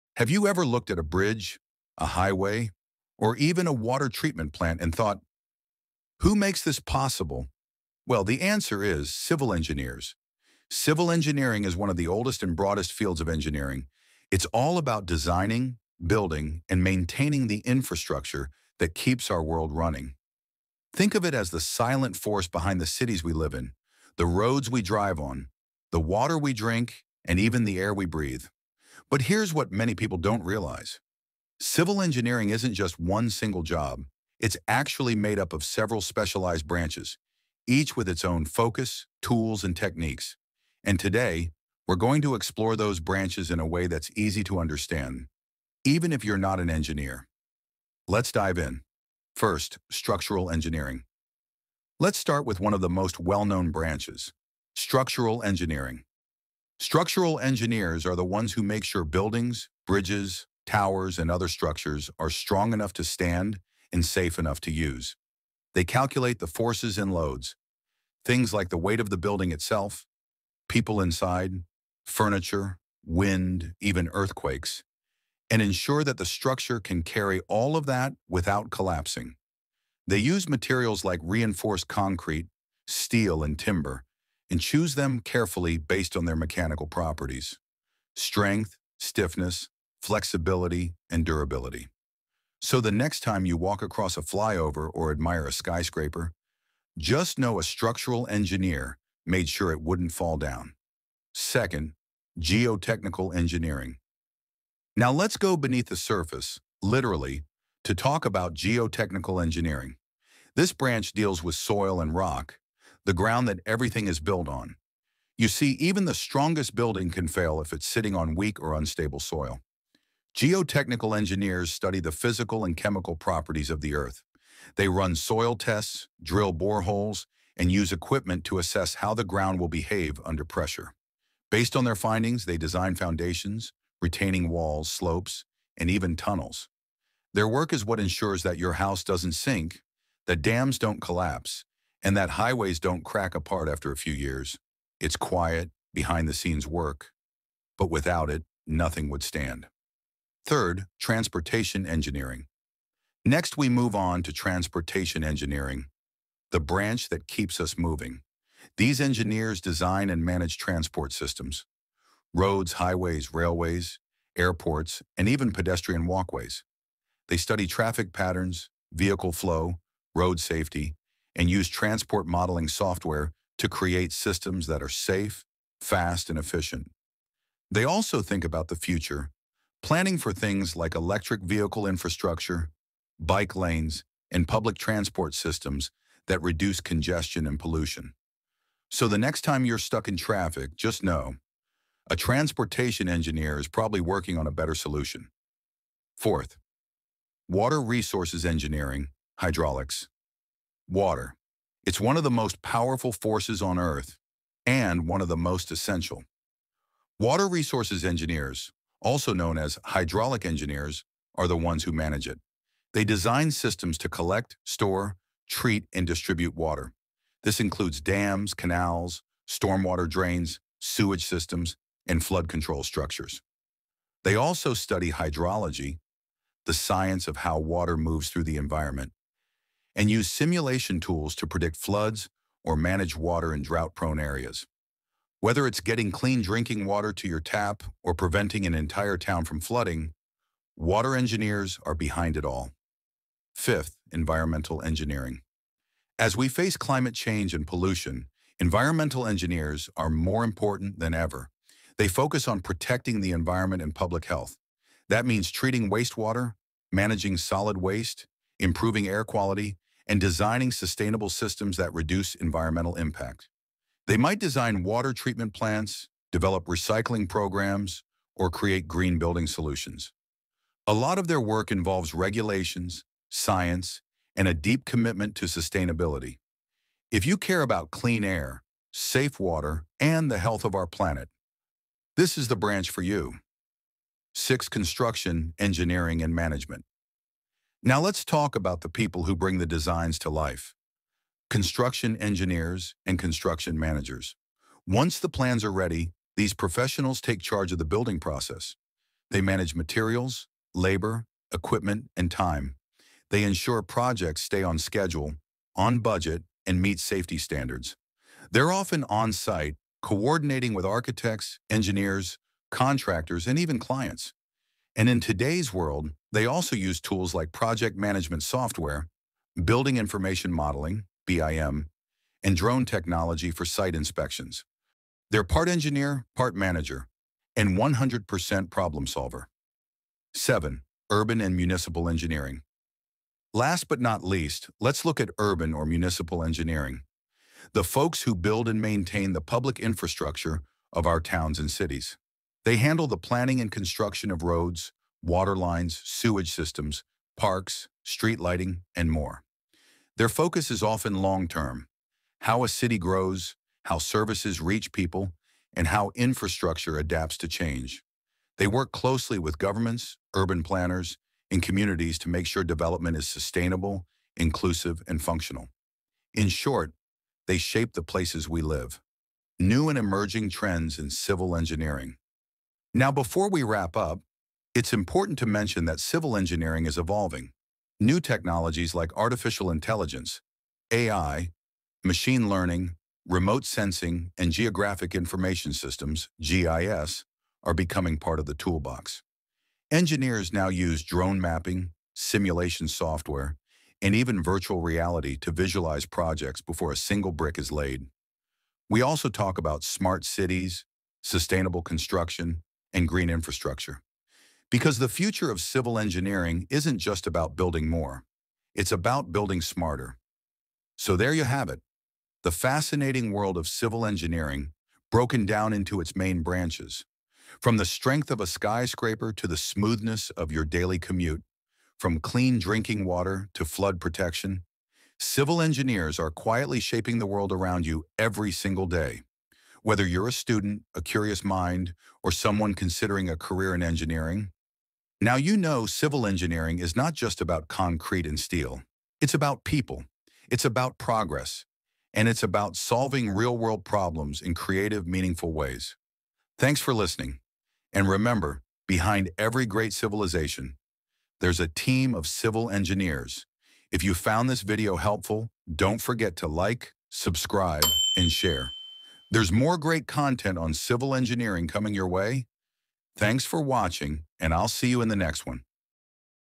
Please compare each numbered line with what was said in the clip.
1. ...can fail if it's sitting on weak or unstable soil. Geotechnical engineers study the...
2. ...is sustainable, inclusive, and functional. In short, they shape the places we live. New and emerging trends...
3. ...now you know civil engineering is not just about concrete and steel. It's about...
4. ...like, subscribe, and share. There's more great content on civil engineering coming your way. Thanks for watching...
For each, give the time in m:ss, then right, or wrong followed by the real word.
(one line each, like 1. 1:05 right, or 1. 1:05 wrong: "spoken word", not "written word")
1. 1:57 right
2. 6:03 right
3. 7:15 right
4. 7:36 right.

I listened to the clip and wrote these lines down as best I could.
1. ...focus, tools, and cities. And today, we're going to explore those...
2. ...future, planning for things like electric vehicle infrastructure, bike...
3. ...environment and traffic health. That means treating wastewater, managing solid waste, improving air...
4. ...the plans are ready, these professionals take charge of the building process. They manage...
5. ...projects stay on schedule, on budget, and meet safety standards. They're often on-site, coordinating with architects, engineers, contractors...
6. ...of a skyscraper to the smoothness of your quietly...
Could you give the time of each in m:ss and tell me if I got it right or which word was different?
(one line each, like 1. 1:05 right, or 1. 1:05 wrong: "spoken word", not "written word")
1. 0:38 wrong: "techniques", not "cities"
2. 2:58 right
3. 4:13 wrong: "public", not "traffic"
4. 4:55 right
5. 5:03 right
6. 6:58 wrong: "daily", not "quietly".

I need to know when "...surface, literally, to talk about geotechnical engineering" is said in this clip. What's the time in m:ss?
1:45.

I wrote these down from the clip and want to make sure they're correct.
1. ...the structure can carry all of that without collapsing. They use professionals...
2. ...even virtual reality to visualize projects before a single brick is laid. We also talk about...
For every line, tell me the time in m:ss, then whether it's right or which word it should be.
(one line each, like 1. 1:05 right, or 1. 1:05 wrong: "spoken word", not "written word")
1. 1:16 wrong: "materials", not "professionals"
2. 6:34 right.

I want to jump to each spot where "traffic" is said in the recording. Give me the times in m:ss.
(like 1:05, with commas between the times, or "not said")
2:47, 3:10.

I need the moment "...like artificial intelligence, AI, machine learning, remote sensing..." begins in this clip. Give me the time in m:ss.
6:18.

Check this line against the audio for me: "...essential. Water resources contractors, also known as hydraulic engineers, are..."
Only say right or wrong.
wrong.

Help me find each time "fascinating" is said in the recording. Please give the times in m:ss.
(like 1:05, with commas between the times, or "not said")
6:52.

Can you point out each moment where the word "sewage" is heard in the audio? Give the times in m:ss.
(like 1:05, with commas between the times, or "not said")
3:40, 5:46.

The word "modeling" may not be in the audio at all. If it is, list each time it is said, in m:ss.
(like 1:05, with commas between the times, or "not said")
2:52, 5:20.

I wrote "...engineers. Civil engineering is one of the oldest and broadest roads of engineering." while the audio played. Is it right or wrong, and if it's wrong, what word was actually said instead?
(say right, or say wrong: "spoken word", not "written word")
wrong: "fields", not "roads".